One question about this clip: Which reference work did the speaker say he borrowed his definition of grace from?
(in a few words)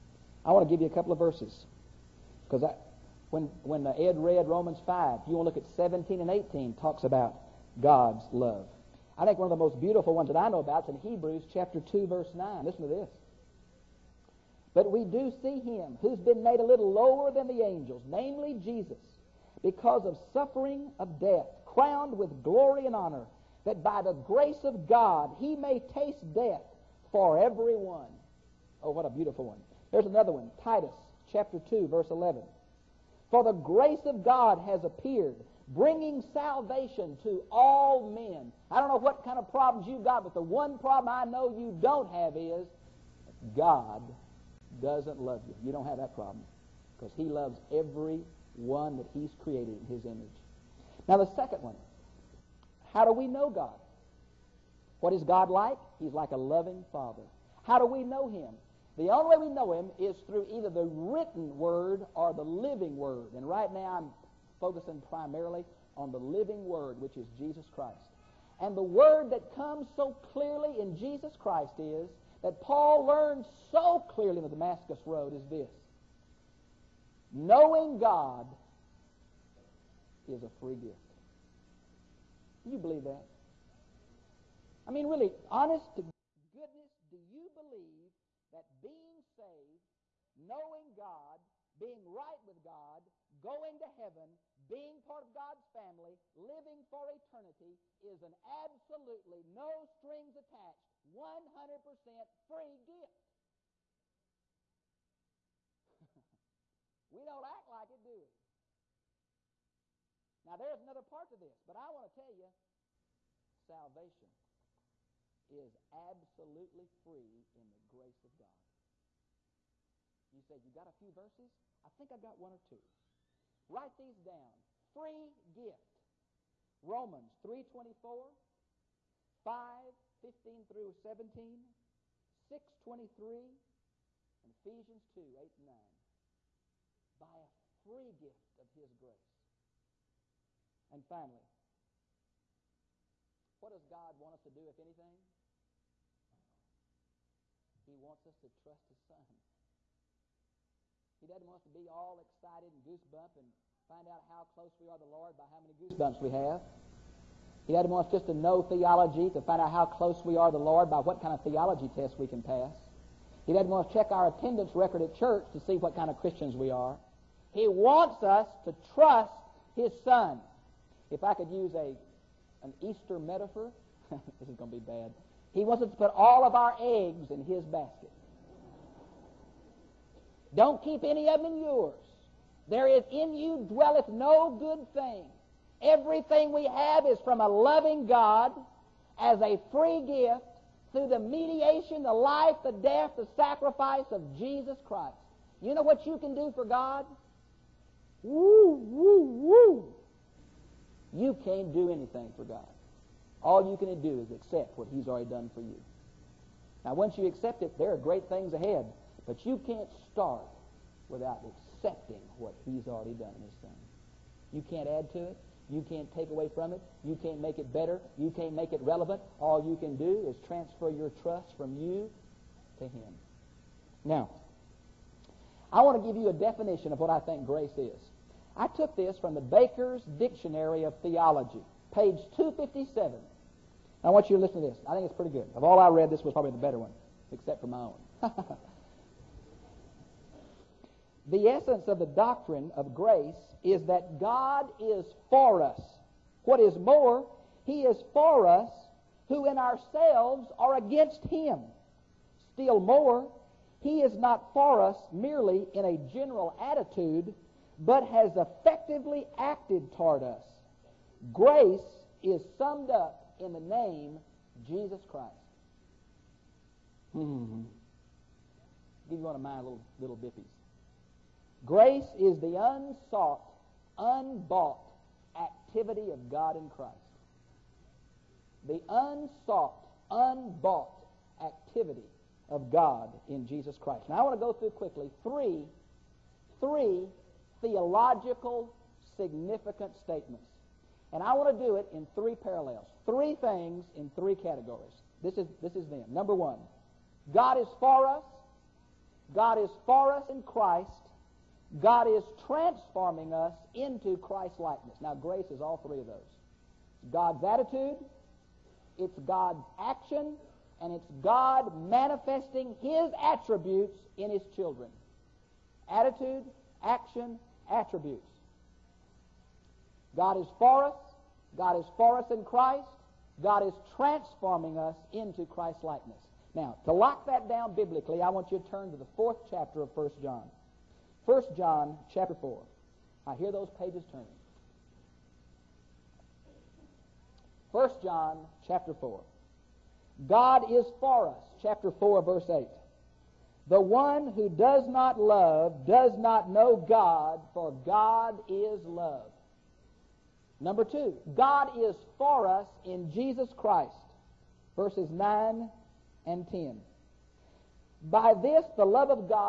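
Baker's Dictionary of Theology.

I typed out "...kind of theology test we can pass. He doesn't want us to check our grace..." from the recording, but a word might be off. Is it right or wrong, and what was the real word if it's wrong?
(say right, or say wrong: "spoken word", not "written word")
wrong: "attendance", not "grace".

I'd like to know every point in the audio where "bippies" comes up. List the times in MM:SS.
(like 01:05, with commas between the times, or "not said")
04:30.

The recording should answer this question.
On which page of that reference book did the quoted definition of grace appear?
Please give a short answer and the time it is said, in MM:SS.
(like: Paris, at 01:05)
257, at 03:51.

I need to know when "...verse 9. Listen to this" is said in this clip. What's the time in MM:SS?
00:12.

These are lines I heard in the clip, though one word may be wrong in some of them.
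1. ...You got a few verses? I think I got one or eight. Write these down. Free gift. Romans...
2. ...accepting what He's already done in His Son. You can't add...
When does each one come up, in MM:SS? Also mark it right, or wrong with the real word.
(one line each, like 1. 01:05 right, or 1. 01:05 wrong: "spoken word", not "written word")
1. 02:00 wrong: "two", not "eight"
2. 03:31 right.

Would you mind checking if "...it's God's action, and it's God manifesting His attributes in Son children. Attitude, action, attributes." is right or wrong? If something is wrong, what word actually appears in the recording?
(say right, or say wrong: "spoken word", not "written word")
wrong: "His", not "Son".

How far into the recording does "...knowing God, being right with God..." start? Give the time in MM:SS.
01:30.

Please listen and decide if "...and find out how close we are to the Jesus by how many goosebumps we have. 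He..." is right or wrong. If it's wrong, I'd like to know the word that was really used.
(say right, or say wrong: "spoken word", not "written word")
wrong: "Lord", not "Jesus".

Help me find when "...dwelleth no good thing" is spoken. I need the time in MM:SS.
03:03.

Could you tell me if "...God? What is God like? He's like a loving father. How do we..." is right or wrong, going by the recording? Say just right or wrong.
right.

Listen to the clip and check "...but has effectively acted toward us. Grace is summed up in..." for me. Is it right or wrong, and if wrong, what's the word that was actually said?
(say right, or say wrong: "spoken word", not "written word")
right.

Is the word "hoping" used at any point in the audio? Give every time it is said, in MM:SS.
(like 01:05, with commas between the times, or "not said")
not said.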